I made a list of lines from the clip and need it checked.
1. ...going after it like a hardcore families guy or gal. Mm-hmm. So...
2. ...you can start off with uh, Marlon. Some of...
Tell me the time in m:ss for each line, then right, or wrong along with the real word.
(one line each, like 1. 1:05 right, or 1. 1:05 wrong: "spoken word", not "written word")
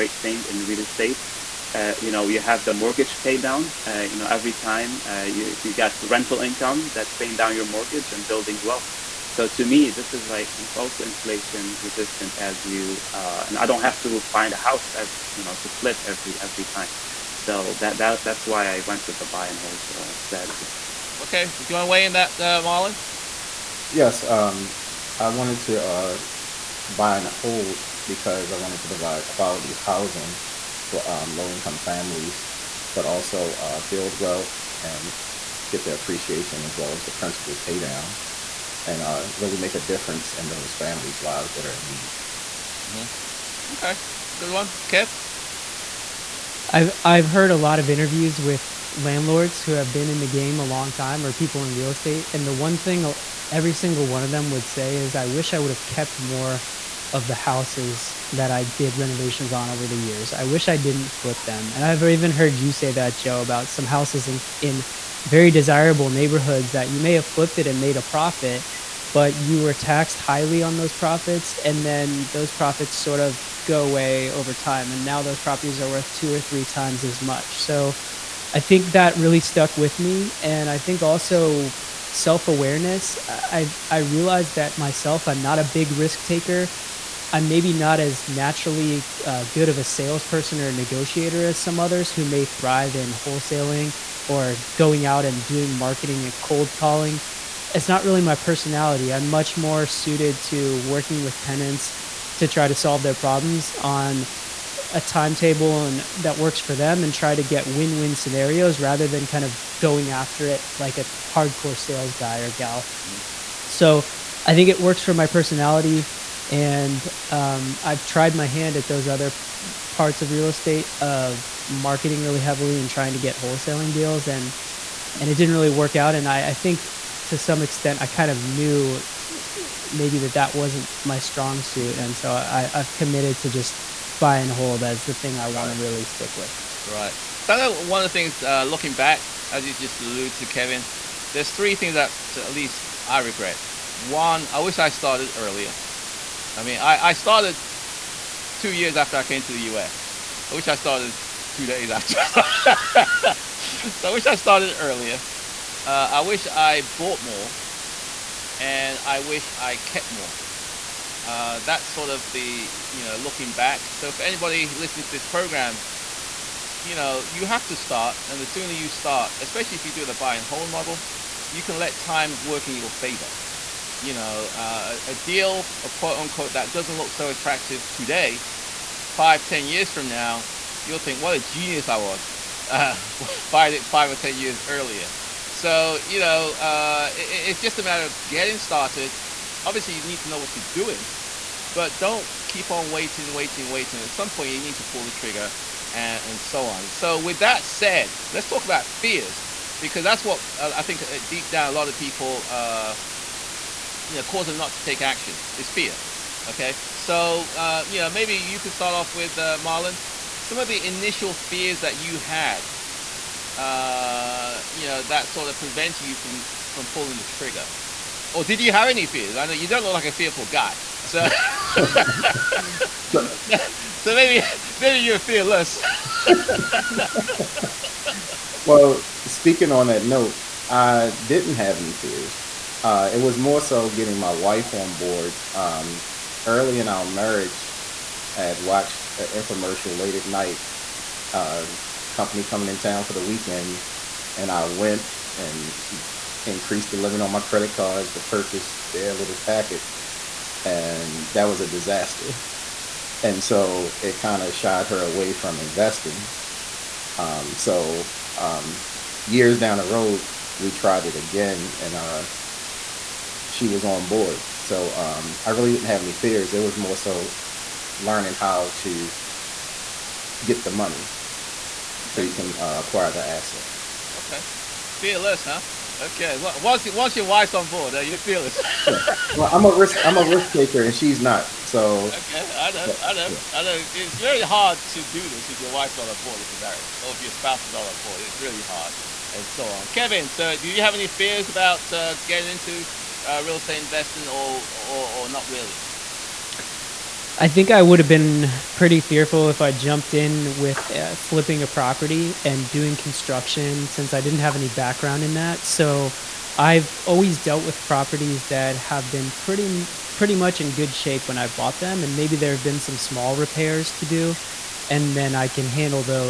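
1. 1:49 wrong: "sales", not "families"
2. 3:28 right.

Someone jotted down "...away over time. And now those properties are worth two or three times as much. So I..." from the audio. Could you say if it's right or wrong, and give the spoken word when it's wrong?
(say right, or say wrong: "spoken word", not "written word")
right.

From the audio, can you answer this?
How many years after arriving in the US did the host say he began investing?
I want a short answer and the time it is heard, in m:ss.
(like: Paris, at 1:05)
2, at 2:28.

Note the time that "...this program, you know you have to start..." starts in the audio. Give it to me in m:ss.
2:45.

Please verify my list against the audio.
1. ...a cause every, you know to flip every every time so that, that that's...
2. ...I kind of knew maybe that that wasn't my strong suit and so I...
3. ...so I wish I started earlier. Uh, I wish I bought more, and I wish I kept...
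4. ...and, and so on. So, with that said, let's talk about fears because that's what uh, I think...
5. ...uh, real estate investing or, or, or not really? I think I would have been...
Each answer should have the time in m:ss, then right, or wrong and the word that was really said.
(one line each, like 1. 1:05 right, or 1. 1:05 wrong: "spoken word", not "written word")
1. 0:14 wrong: "house", not "cause"
2. 2:08 right
3. 2:33 right
4. 3:15 right
5. 4:53 right.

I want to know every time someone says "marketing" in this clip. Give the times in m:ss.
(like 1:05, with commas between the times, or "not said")
1:35, 2:01.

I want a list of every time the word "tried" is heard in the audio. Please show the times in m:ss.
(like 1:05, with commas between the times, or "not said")
1:58, 4:20.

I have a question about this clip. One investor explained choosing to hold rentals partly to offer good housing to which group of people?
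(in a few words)
low income families.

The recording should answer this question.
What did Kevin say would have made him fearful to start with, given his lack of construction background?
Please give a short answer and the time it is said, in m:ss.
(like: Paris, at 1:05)
flipping a property, at 5:01.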